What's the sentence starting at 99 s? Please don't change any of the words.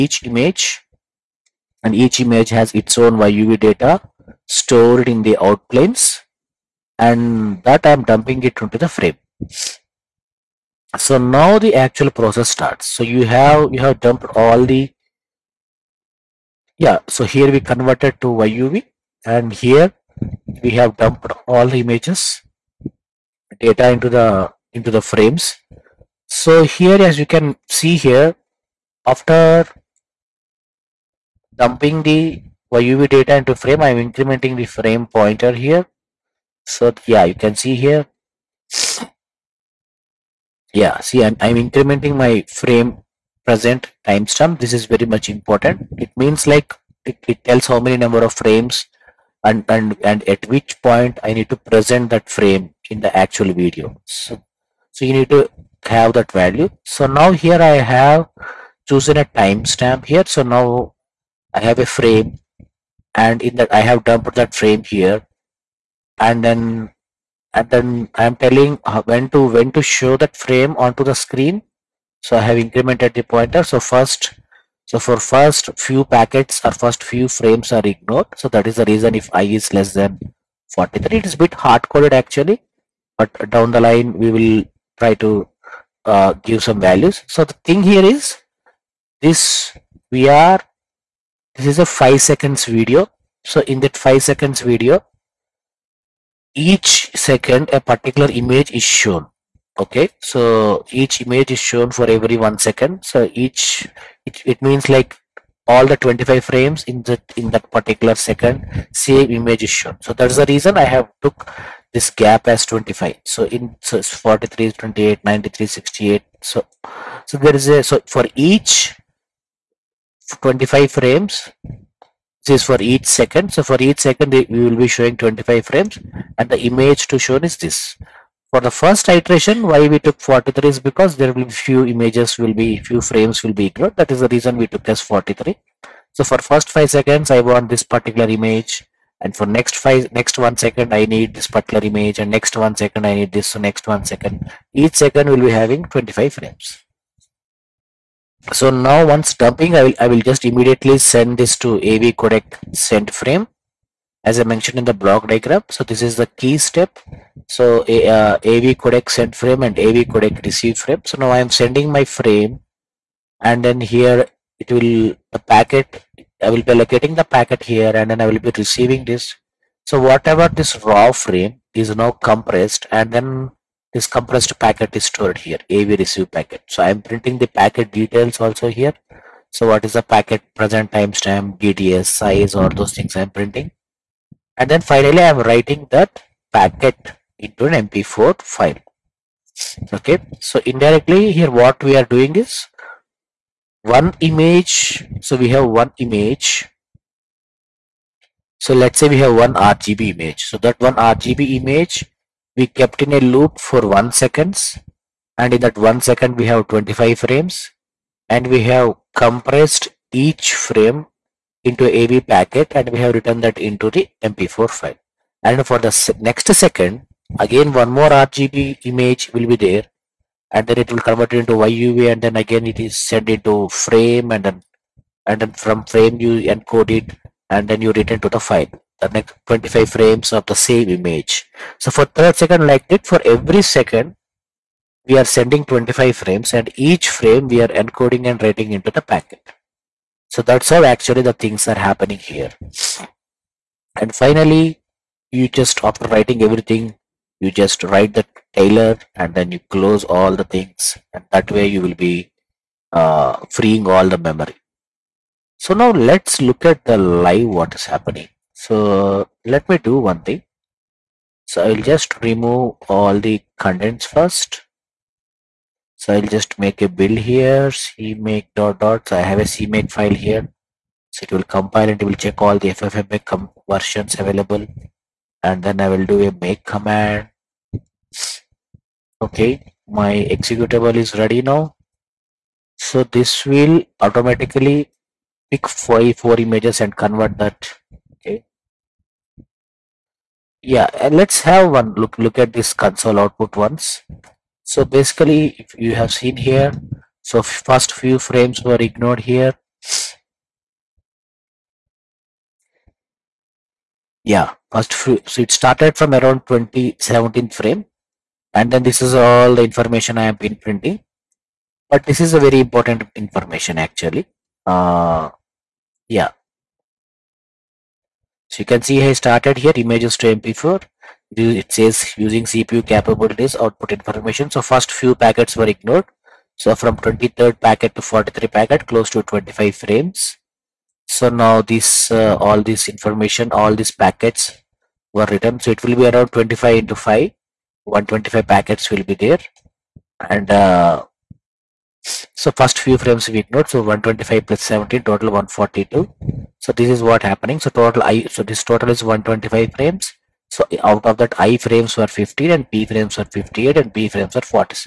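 Okay, so each image is shown for every one second.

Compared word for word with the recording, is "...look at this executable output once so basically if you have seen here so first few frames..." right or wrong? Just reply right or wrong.
wrong.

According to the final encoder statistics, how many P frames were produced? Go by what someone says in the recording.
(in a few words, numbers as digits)
58.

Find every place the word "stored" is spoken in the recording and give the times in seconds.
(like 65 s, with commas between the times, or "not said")
4 s, 175 s.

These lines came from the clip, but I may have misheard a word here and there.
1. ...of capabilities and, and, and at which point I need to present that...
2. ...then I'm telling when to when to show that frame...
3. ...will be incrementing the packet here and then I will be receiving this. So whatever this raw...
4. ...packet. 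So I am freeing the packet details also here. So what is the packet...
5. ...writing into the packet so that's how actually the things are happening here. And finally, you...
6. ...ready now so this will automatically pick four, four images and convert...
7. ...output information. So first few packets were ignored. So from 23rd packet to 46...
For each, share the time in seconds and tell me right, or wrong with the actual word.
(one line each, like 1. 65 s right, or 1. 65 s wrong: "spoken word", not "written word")
1. 48 s wrong: "frames", not "capabilities"
2. 67 s right
3. 166 s wrong: "allocating", not "incrementing"
4. 176 s wrong: "printing", not "freeing"
5. 238 s right
6. 281 s right
7. 323 s wrong: "43", not "46".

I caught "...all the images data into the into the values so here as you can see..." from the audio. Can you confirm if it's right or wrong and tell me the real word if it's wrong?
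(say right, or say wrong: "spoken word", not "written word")
wrong: "frames", not "values".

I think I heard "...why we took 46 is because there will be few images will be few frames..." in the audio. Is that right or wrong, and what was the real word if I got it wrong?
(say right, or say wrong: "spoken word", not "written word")
wrong: "43", not "46".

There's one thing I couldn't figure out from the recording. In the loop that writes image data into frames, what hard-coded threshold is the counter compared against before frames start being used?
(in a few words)
43.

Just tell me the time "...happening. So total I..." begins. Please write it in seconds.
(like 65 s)
347 s.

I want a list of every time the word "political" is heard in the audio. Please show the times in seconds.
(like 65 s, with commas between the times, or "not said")
not said.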